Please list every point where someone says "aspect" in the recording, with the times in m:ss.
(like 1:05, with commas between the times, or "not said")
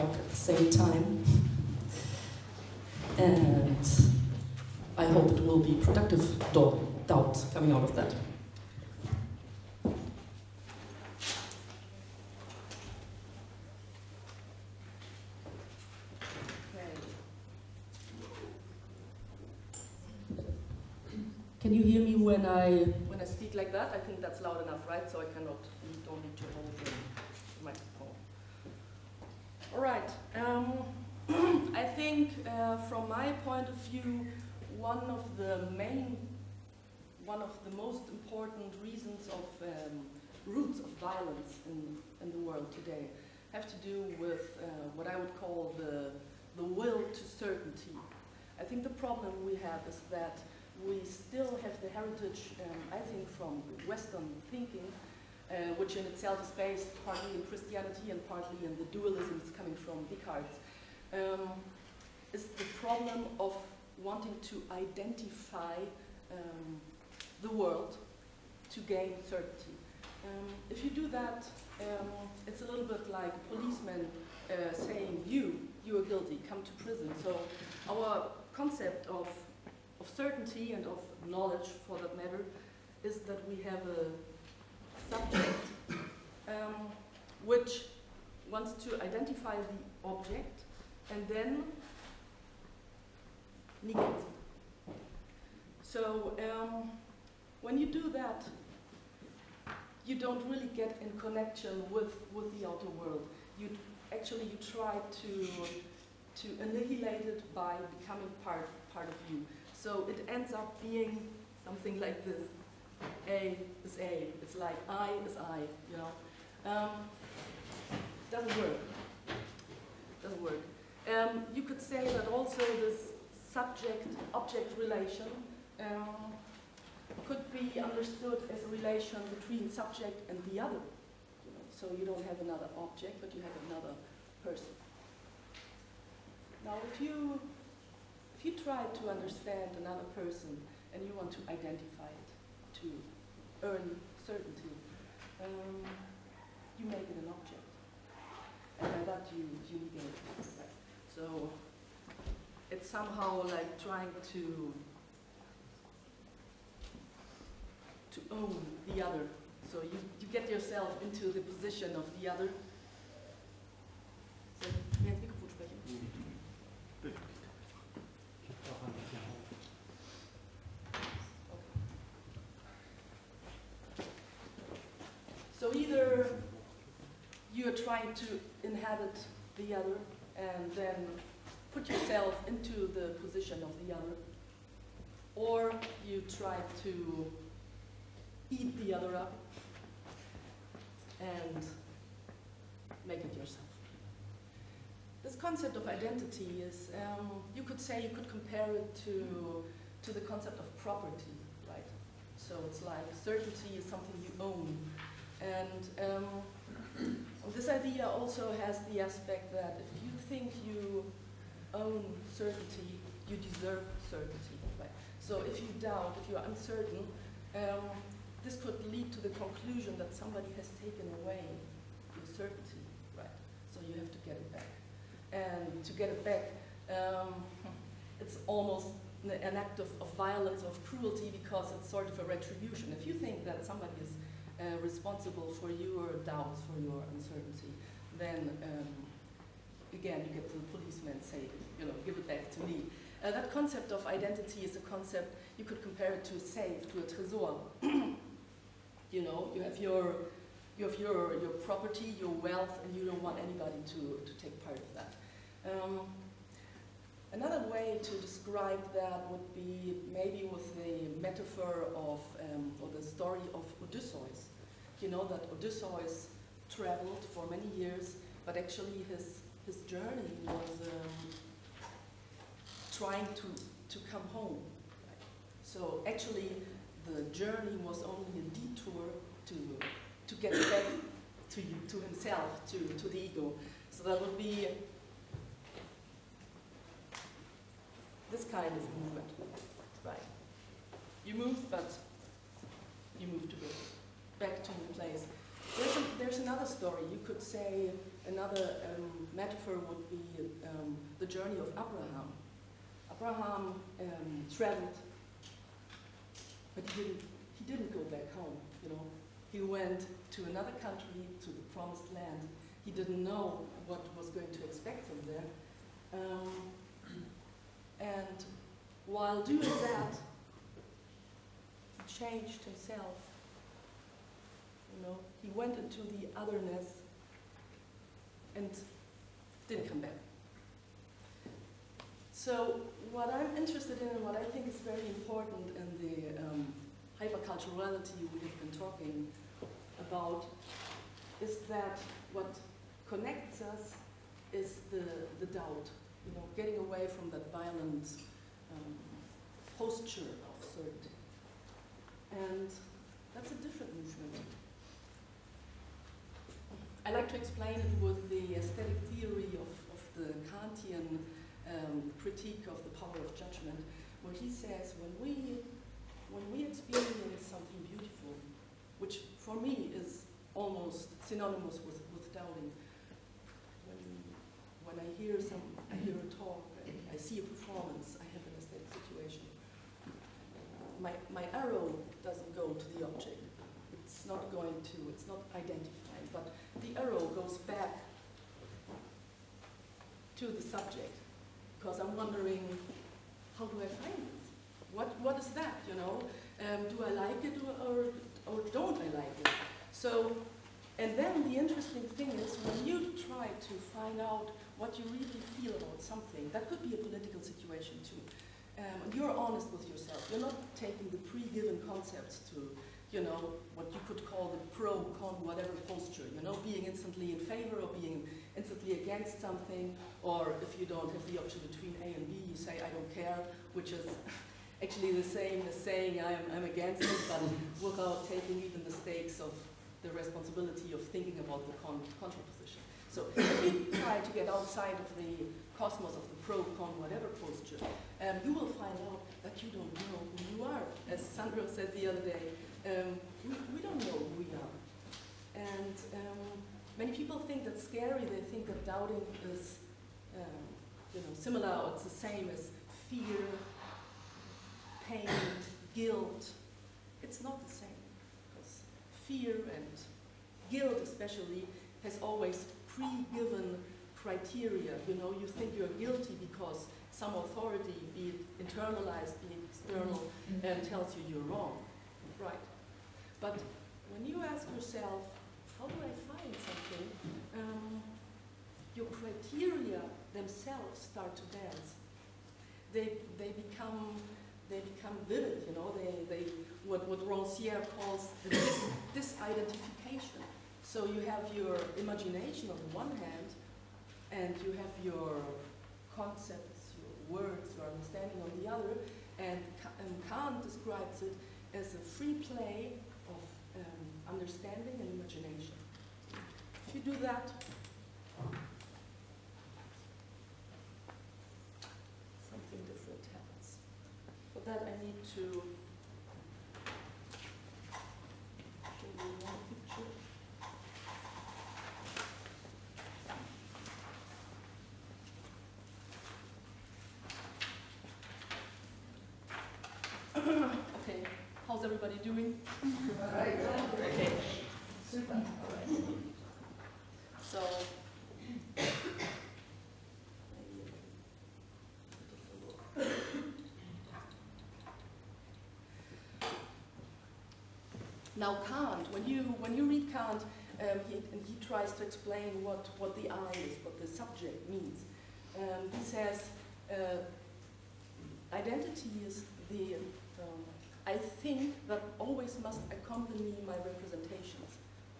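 3:28.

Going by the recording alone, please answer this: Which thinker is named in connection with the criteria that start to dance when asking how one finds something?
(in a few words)
Rancière.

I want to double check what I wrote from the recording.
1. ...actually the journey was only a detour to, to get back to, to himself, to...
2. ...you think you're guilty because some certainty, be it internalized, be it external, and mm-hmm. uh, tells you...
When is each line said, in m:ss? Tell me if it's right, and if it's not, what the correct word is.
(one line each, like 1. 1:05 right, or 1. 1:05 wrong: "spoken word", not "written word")
1. 4:36 right
2. 7:45 wrong: "authority", not "certainty".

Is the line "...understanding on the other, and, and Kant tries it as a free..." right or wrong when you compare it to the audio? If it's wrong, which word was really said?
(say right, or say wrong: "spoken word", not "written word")
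wrong: "describes", not "tries".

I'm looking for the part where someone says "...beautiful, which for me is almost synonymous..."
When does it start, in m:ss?
6:07.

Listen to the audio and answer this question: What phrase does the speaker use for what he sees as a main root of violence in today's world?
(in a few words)
the will to certainty.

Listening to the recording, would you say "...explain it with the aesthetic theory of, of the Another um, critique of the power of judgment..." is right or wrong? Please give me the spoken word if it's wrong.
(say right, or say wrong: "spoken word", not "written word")
wrong: "Kantian", not "Another".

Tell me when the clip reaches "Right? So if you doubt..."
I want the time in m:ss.
3:34.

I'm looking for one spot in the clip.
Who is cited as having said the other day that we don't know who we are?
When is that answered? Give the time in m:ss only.
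7:21.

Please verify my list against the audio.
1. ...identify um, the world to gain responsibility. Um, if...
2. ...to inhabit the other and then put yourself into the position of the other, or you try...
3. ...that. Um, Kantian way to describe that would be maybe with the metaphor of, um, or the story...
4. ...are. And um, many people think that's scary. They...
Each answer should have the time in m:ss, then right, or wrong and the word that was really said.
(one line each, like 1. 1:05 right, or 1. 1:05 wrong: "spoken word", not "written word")
1. 1:04 wrong: "certainty", not "responsibility"
2. 2:58 right
3. 4:14 wrong: "Another", not "Kantian"
4. 7:24 right.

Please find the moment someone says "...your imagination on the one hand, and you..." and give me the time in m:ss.
8:11.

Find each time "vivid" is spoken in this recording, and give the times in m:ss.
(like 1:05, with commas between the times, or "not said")
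8:05.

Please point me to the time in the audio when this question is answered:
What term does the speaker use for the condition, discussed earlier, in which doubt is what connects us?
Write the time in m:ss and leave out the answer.
5:37.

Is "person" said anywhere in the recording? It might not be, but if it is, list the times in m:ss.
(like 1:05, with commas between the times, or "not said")
2:14, 2:20.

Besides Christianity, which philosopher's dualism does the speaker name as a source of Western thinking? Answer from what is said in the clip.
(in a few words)
Descartes.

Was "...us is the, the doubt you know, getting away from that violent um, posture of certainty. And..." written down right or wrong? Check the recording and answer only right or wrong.
right.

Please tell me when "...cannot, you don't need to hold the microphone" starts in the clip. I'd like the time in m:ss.
0:25.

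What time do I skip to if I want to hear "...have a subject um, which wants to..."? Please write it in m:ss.
1:23.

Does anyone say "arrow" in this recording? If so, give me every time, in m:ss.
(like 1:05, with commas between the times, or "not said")
6:21, 6:26.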